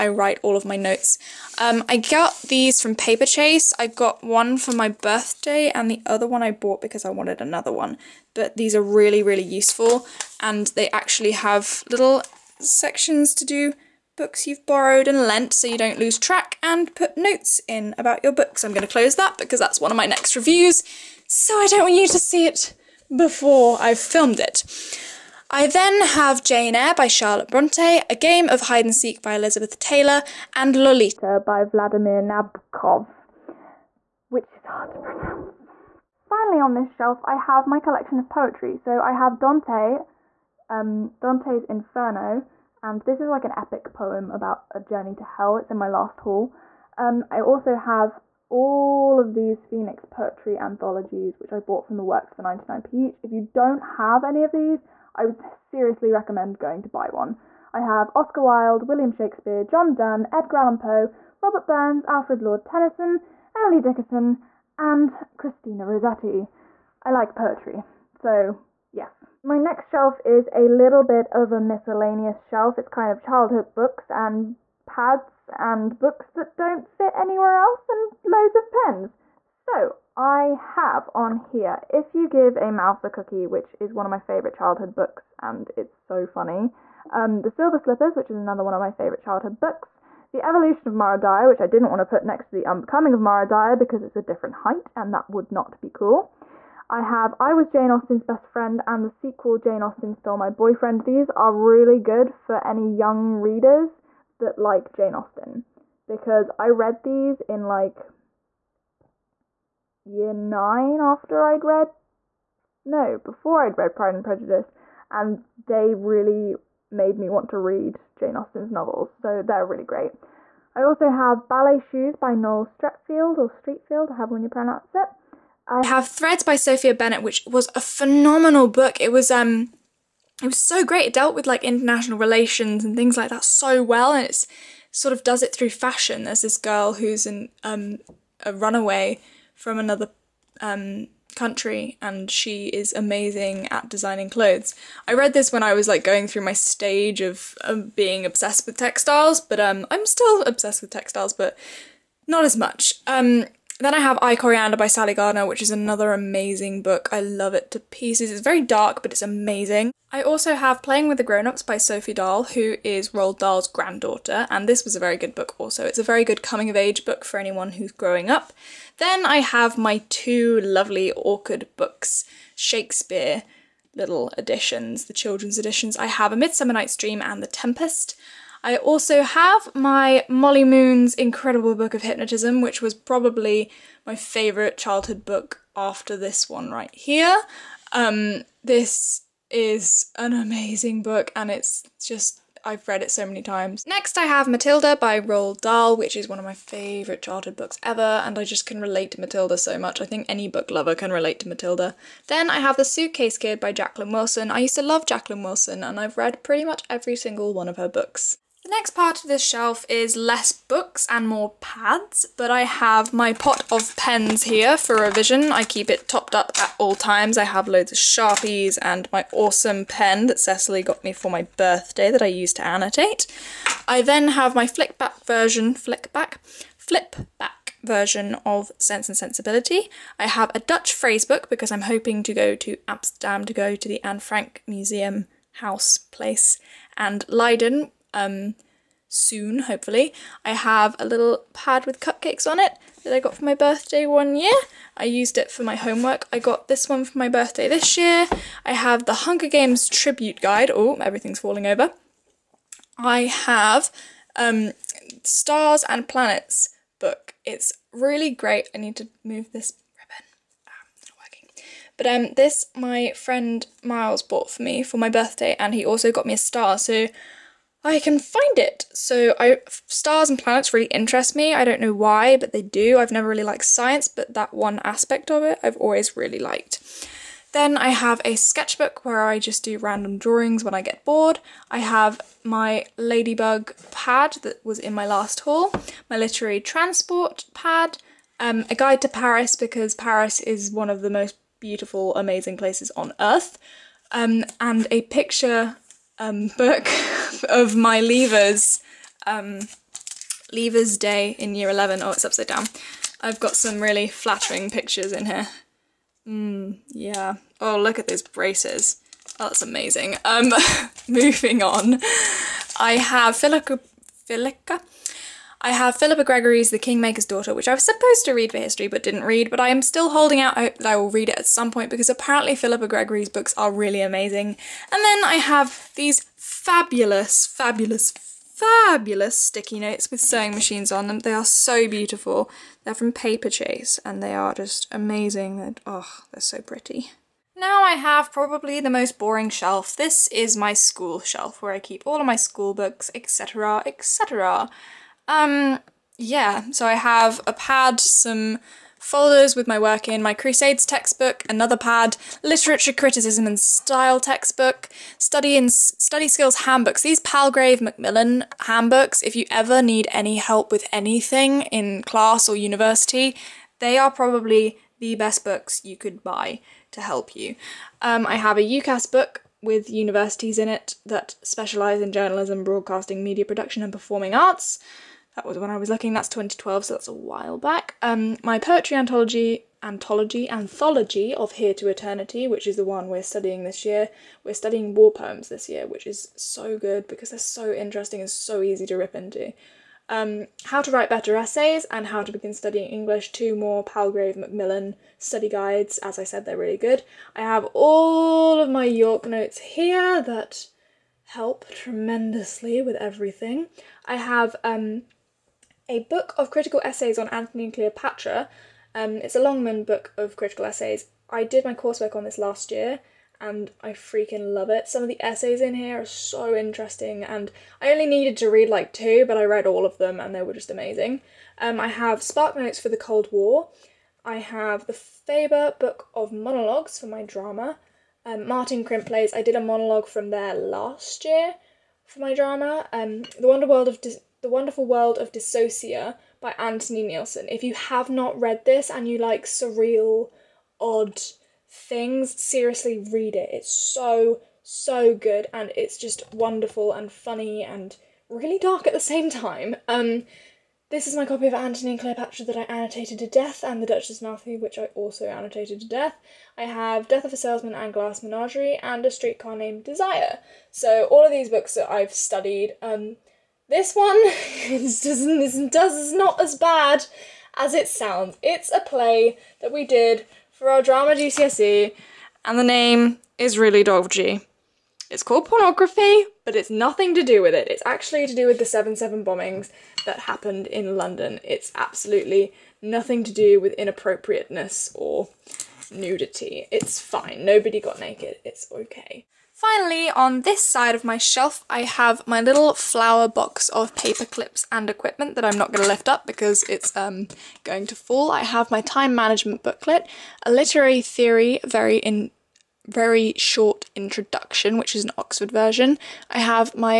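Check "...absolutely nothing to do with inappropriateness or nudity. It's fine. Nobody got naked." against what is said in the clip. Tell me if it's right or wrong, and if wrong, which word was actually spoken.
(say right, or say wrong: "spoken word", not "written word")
right.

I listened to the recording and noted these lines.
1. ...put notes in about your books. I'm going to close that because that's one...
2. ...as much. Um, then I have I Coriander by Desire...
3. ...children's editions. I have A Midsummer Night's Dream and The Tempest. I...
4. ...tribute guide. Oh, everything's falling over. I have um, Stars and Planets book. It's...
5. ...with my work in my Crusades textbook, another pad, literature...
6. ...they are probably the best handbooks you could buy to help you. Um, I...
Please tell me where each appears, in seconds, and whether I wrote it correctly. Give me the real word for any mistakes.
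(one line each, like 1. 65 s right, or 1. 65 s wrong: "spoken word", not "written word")
1. 16 s right
2. 152 s wrong: "Sally", not "Desire"
3. 175 s right
4. 249 s right
5. 349 s right
6. 363 s wrong: "books", not "handbooks".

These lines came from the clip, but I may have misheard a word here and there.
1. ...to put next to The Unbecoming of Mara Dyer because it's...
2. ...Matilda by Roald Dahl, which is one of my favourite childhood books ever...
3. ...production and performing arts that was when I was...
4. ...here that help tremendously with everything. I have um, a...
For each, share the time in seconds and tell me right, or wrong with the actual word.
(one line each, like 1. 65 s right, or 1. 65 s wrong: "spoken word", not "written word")
1. 92 s right
2. 194 s right
3. 373 s right
4. 399 s right.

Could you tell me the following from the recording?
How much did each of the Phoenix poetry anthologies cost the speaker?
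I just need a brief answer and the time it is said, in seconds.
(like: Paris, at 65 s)
99p, at 52 s.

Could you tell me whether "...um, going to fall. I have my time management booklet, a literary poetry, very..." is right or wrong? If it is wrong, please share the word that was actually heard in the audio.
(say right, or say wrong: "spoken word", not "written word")
wrong: "theory", not "poetry".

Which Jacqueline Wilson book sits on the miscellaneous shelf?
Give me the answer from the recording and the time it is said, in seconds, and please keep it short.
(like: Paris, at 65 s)
The Suitcase Kid, at 202 s.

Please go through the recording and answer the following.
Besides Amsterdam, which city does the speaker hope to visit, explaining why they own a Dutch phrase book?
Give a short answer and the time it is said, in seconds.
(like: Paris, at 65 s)
Leiden, at 237 s.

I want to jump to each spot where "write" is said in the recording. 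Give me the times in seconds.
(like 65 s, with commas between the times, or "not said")
0 s, 390 s.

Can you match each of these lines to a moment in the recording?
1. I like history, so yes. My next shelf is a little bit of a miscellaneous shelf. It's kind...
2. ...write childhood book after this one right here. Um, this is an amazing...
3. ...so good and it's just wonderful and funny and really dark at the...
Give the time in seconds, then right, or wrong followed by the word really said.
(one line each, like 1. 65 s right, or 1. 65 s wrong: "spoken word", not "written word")
1. 67 s wrong: "poetry", not "history"
2. 184 s wrong: "favourite", not "write"
3. 444 s right.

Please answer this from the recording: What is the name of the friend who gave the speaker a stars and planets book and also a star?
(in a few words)
Miles.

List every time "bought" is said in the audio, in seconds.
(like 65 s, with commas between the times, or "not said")
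6 s, 51 s, 264 s.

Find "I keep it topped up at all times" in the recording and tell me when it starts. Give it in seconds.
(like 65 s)
215 s.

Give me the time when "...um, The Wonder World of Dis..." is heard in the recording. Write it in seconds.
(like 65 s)
432 s.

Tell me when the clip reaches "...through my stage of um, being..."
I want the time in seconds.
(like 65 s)
146 s.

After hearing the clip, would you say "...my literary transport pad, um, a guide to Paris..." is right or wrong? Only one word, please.
right.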